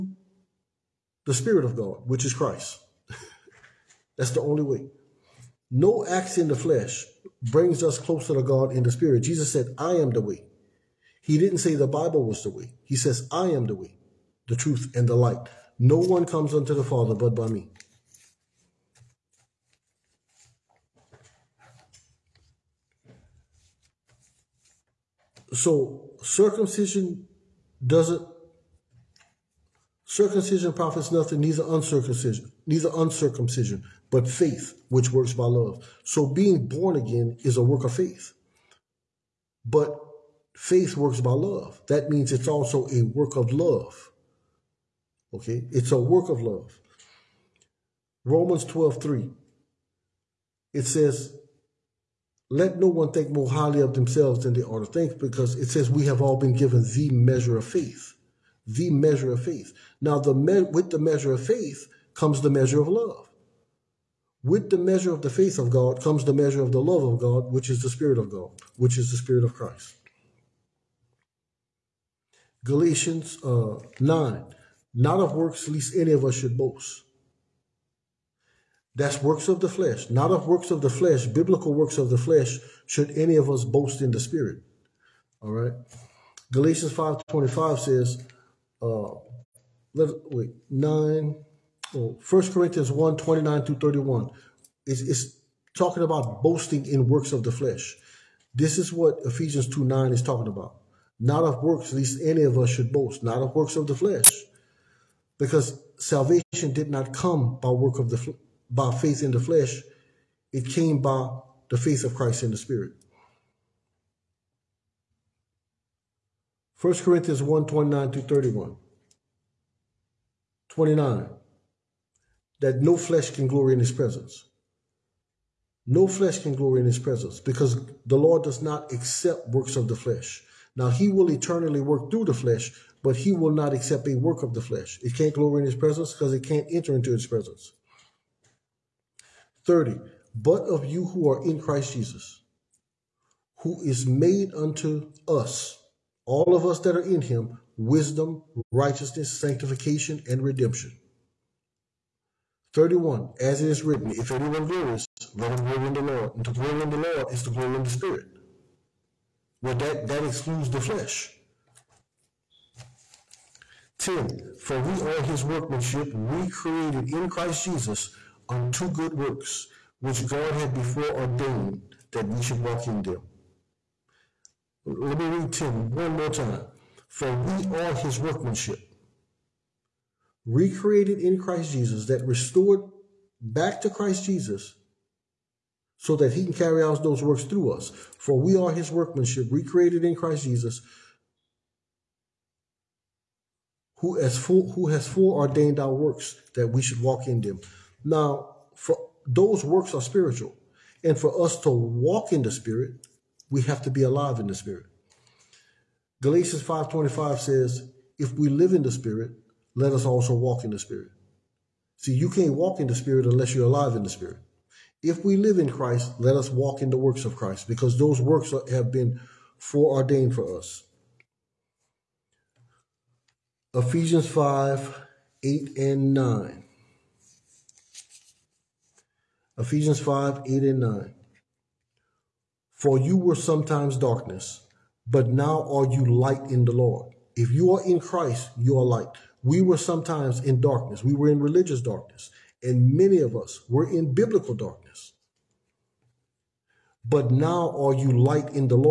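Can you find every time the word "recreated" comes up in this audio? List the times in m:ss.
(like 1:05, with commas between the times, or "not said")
2:46, 3:00, 3:09.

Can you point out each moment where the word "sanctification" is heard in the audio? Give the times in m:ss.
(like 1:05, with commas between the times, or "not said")
2:29.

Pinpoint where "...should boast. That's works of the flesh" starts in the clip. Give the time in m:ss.
1:16.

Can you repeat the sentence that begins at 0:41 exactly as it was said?
That means it's also a work of love.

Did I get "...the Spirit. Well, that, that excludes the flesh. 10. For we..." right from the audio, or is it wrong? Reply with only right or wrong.
right.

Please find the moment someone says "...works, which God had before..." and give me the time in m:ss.
2:49.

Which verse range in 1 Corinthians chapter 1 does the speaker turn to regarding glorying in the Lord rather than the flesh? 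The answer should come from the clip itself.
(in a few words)
29 through 31.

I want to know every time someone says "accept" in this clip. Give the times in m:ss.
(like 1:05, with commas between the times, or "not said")
2:08, 2:13.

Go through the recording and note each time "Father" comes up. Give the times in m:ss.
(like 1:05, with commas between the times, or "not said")
0:16.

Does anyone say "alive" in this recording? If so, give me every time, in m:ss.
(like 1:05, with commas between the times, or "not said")
3:24, 3:33.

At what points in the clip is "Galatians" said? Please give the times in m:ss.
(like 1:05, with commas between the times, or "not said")
1:12, 1:26, 3:26.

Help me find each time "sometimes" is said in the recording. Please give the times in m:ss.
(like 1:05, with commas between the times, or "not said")
3:53, 3:59.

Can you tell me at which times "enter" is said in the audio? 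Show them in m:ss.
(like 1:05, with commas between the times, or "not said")
2:16.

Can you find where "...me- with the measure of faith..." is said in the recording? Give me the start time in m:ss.
1:00.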